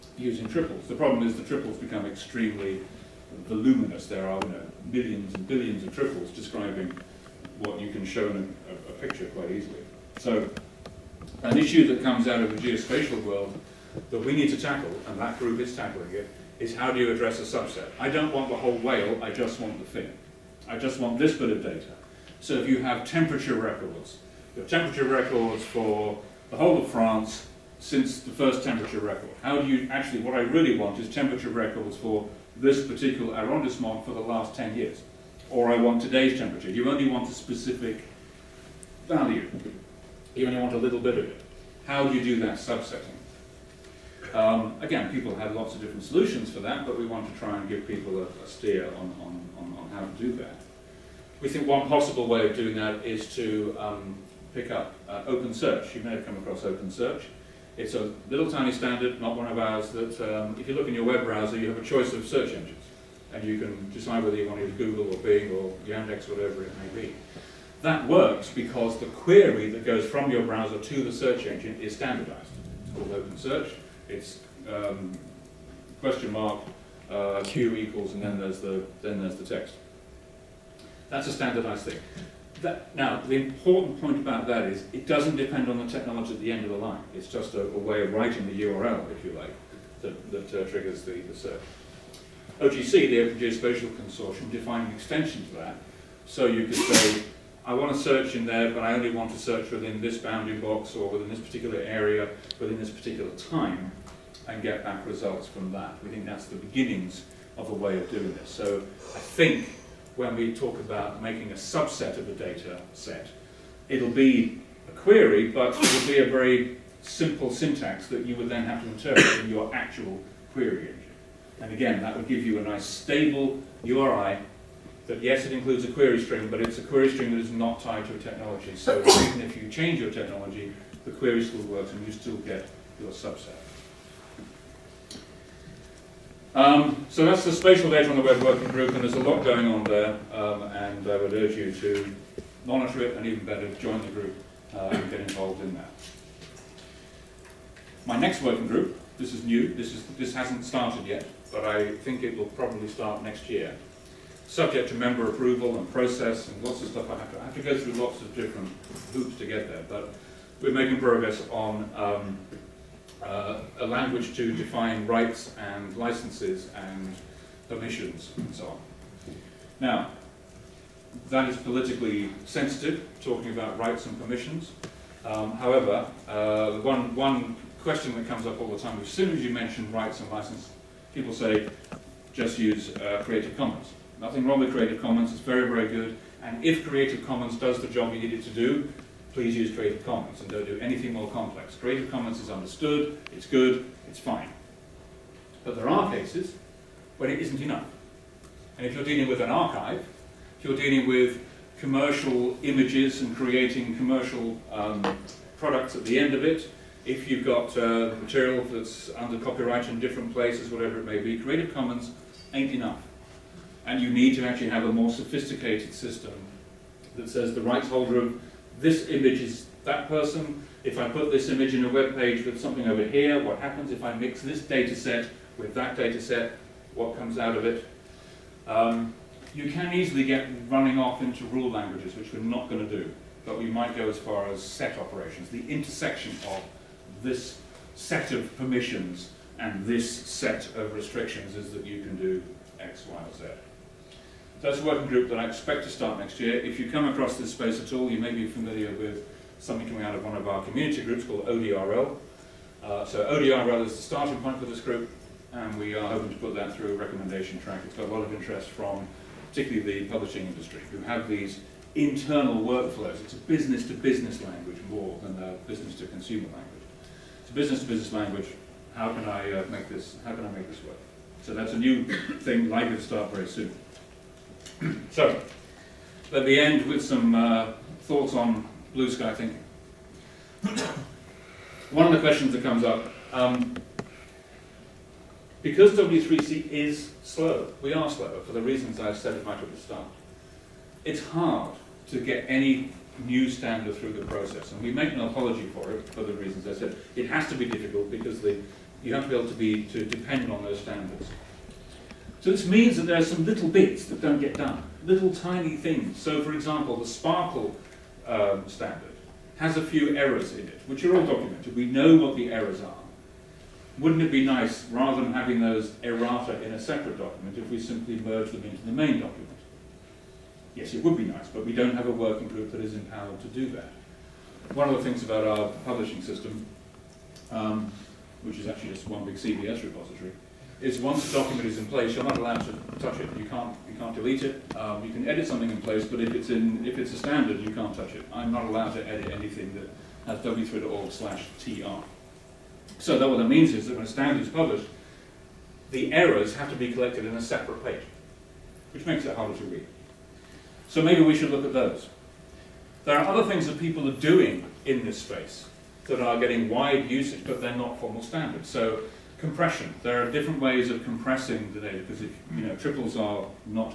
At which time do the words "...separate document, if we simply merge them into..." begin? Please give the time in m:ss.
5:16.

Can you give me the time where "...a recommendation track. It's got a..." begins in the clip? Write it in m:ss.
4:16.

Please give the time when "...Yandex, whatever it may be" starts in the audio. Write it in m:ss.
1:05.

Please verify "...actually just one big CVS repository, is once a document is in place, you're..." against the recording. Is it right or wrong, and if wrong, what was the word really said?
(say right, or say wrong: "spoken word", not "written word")
right.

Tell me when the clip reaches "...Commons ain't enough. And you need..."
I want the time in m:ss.
3:31.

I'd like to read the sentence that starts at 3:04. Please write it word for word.
Nothing wrong with Creative Commons, it's very, very good.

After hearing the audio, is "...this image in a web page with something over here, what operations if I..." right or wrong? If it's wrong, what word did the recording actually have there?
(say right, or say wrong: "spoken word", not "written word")
wrong: "happens", not "operations".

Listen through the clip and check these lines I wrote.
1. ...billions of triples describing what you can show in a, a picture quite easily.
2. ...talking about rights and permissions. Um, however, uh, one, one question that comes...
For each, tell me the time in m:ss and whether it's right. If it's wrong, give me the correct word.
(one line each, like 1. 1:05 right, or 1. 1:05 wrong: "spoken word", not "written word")
1. 0:05 right
2. 2:53 right.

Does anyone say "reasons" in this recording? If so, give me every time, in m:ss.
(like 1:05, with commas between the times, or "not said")
4:48, 4:56.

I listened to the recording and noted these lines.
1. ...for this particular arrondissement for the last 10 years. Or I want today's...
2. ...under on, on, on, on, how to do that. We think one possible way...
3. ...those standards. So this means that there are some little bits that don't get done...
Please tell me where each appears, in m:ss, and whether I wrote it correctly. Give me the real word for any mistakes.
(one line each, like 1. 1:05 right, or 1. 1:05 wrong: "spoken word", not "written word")
1. 0:31 right
2. 0:48 wrong: "steer", not "under"
3. 5:00 right.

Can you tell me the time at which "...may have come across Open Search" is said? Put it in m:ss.
0:56.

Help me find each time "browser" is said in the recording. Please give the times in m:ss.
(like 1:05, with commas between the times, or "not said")
1:01, 1:10.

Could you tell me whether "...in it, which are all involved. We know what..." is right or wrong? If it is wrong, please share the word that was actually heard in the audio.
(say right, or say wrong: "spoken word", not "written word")
wrong: "documented", not "involved".